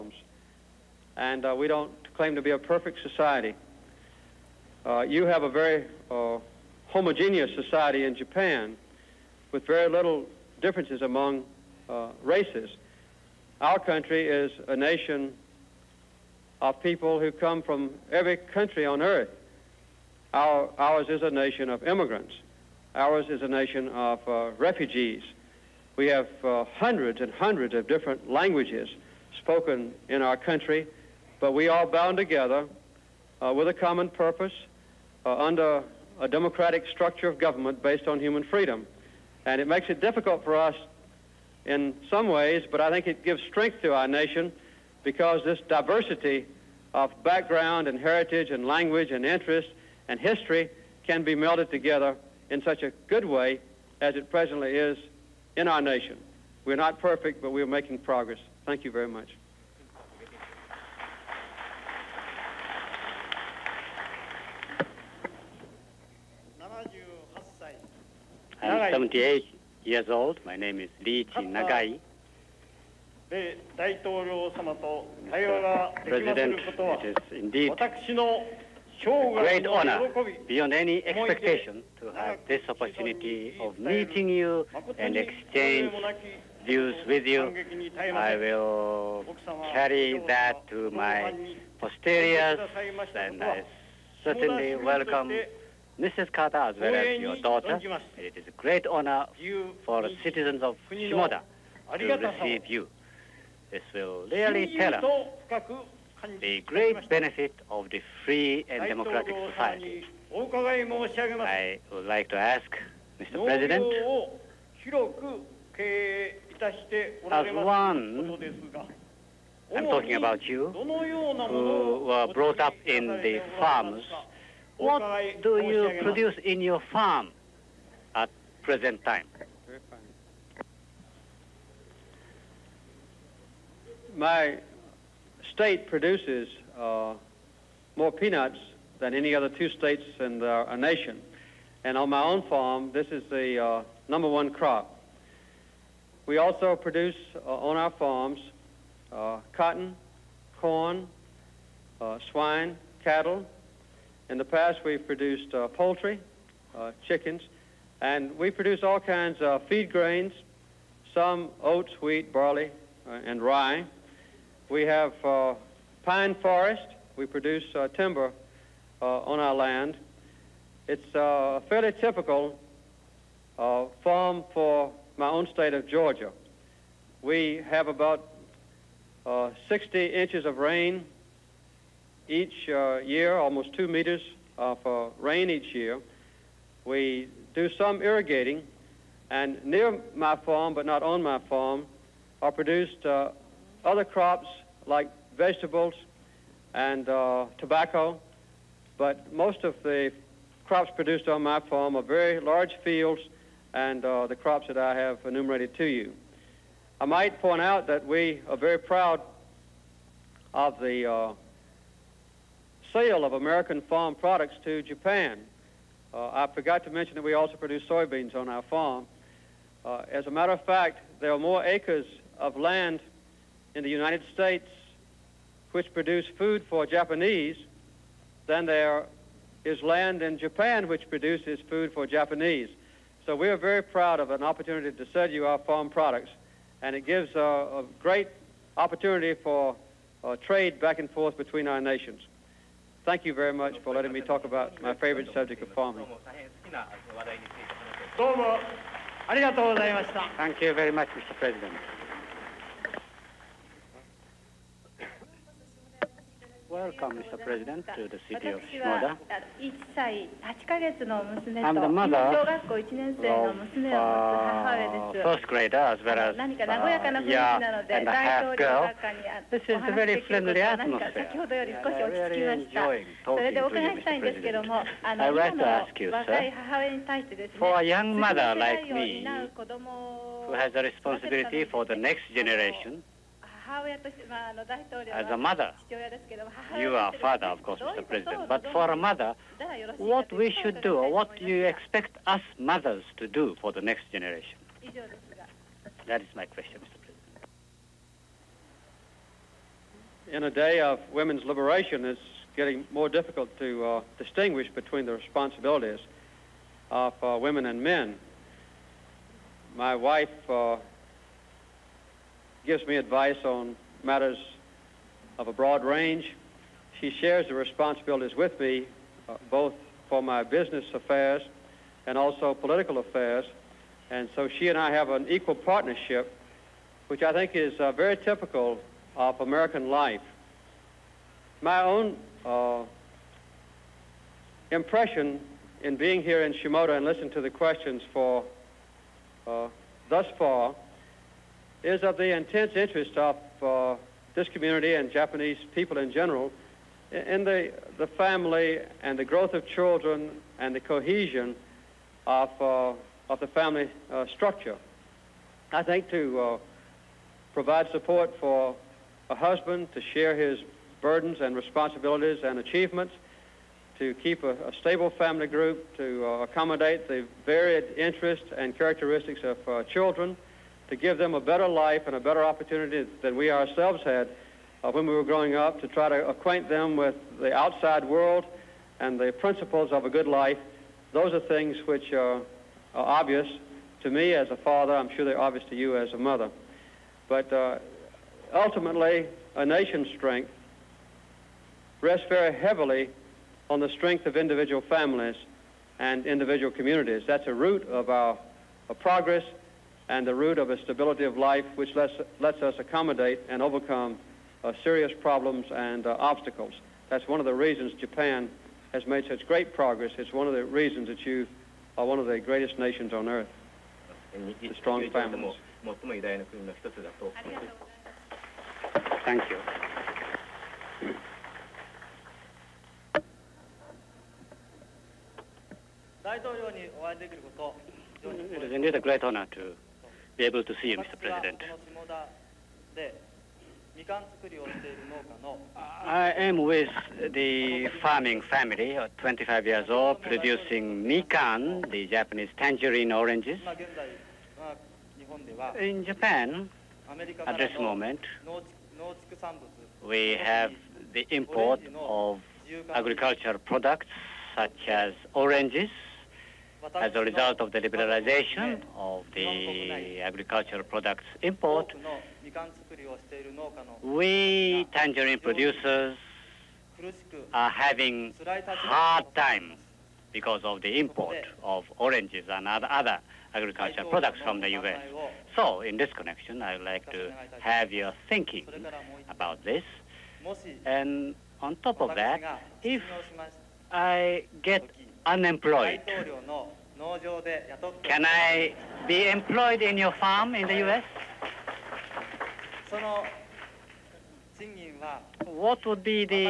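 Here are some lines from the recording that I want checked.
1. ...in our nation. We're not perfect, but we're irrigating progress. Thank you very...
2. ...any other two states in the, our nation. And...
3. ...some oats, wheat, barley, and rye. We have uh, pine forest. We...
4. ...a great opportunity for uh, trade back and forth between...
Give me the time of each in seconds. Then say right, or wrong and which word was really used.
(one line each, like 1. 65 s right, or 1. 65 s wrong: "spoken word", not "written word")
1. 55 s wrong: "making", not "irrigating"
2. 139 s right
3. 161 s right
4. 237 s right.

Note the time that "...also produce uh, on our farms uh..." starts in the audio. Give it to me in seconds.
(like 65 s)
146 s.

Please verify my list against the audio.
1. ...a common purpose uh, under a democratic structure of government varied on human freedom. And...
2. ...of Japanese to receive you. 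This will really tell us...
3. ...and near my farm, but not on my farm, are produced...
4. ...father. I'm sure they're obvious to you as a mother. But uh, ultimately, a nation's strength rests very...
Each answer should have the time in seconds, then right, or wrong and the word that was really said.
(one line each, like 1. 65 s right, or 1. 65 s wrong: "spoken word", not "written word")
1. 33 s wrong: "based", not "varied"
2. 100 s wrong: "Shimoda", not "Japanese"
3. 189 s right
4. 384 s right.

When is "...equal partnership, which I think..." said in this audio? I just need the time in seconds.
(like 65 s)
325 s.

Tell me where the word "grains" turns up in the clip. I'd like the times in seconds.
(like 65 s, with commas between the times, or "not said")
159 s.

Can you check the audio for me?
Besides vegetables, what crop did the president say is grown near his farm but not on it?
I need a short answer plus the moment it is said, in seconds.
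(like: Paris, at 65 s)
tobacco, at 197 s.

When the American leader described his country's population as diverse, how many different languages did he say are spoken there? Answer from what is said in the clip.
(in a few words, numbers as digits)
hundreds and hundreds.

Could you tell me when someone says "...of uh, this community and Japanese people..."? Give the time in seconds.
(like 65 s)
343 s.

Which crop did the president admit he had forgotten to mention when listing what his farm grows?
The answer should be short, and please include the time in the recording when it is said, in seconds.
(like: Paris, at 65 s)
soybeans, at 217 s.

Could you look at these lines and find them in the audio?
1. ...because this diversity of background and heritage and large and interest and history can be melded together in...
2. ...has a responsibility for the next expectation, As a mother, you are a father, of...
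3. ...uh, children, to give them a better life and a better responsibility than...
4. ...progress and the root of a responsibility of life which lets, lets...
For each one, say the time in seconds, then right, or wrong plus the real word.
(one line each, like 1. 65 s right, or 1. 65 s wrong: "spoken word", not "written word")
1. 45 s wrong: "language", not "large"
2. 280 s wrong: "generation", not "expectation"
3. 369 s wrong: "opportunity", not "responsibility"
4. 399 s wrong: "stability", not "responsibility".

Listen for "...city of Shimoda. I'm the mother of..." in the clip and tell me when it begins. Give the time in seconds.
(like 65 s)
258 s.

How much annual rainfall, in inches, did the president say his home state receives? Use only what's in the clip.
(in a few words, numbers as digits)
60 inches.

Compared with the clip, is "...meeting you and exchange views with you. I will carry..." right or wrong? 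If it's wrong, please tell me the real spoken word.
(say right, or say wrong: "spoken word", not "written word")
right.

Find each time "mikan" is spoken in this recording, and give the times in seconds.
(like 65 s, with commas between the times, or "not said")
441 s.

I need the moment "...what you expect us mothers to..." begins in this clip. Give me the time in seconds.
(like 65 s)
291 s.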